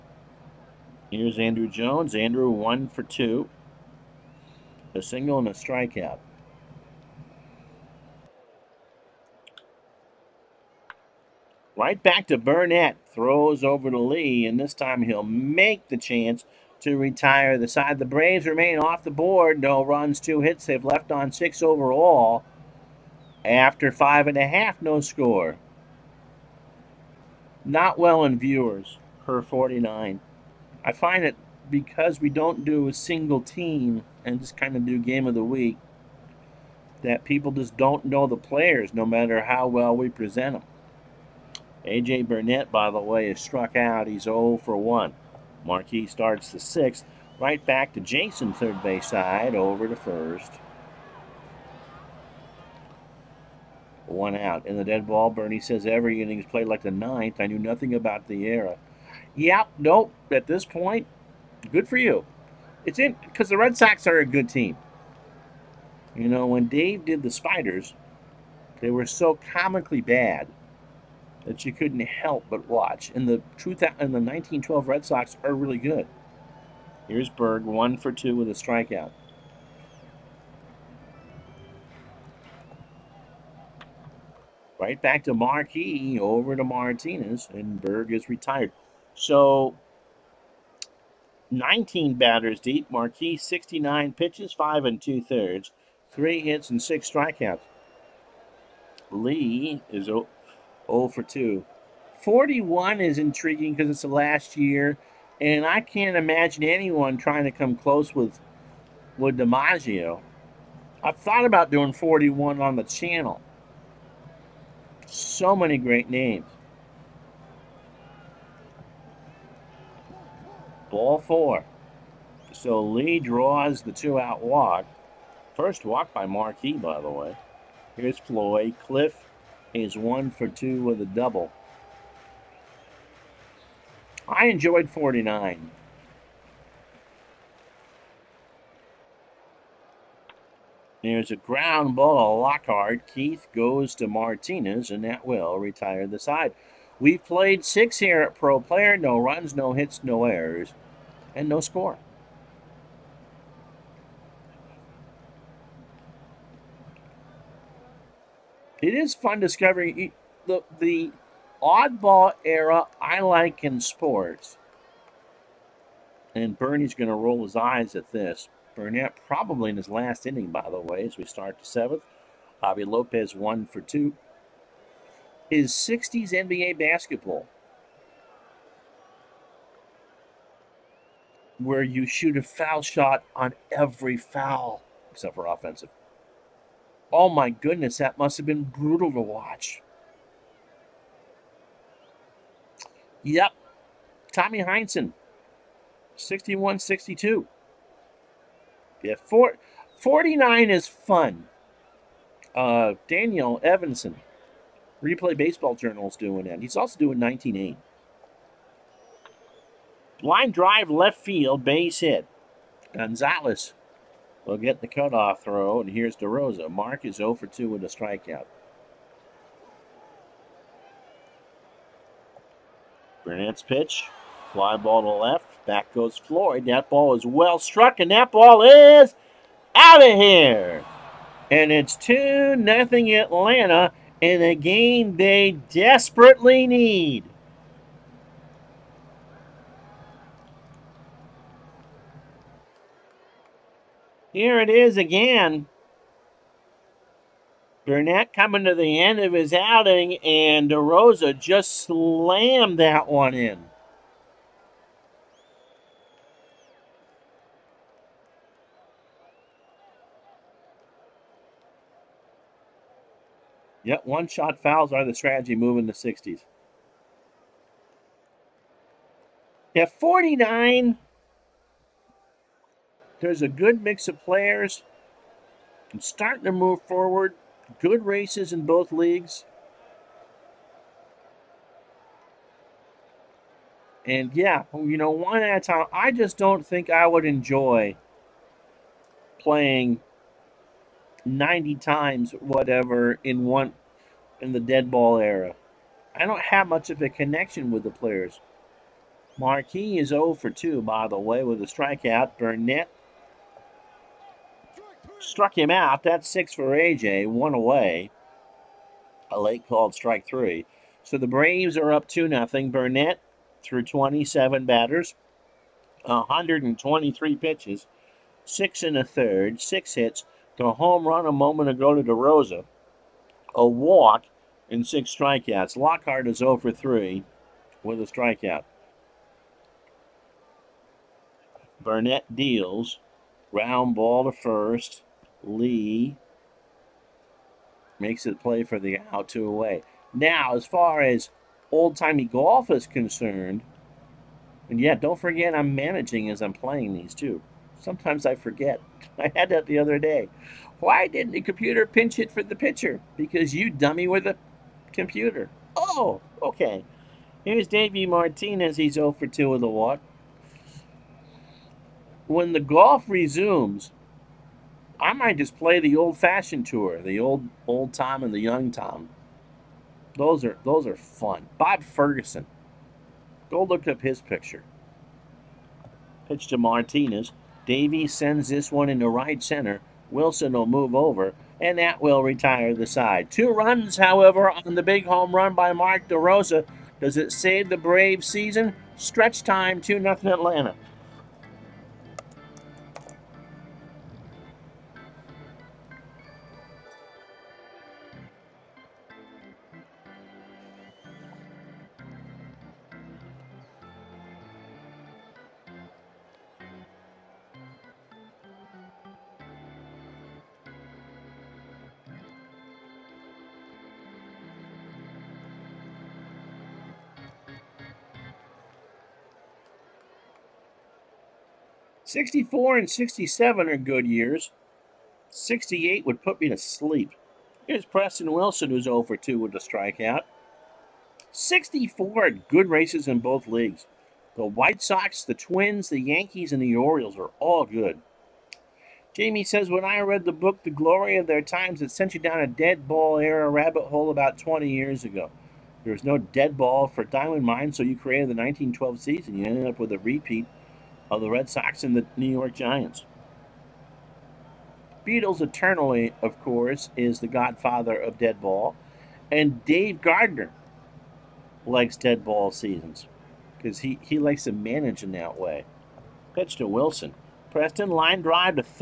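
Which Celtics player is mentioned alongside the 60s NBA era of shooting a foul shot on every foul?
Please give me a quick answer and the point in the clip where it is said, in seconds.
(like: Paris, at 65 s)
Tommy Heinsohn, at 194 s.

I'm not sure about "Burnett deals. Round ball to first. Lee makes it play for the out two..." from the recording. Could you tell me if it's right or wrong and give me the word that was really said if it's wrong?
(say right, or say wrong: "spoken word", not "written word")
right.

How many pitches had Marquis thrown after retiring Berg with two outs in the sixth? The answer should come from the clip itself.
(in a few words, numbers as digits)
69.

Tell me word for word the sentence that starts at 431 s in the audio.
64 good races in both leagues.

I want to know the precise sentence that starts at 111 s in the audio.
I've thought about doing 41 on the channel.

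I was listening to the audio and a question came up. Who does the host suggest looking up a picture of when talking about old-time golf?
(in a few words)
Bob Ferguson.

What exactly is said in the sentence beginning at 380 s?
Wilson will move over, and that will retire the side.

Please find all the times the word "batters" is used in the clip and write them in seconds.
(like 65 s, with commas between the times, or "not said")
92 s, 314 s.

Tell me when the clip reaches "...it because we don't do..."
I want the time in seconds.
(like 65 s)
31 s.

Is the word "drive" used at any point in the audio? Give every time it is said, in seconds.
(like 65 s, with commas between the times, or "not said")
210 s, 468 s.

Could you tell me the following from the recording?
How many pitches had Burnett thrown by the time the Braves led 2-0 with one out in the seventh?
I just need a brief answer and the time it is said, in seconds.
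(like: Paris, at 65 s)
123, at 316 s.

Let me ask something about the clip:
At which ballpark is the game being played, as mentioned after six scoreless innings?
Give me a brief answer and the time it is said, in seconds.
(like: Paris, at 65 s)
Pro Player, at 148 s.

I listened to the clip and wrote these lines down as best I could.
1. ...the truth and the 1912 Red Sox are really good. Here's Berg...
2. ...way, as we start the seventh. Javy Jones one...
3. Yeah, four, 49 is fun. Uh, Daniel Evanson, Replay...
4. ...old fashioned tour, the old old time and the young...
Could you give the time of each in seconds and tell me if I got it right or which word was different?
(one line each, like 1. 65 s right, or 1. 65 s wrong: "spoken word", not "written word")
1. 73 s right
2. 170 s wrong: "Lopez", not "Jones"
3. 199 s right
4. 365 s right.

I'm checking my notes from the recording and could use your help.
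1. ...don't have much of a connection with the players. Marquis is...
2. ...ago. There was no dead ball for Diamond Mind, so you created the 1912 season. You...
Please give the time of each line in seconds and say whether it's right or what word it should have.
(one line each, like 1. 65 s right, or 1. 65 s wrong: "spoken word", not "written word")
1. 296 s right
2. 445 s right.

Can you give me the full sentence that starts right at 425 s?
68 would put me to sleep.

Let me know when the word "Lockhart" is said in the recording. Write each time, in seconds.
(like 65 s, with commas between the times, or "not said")
142 s, 325 s.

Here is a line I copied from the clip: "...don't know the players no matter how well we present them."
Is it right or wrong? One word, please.
right.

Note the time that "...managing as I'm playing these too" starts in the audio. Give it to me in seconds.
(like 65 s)
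345 s.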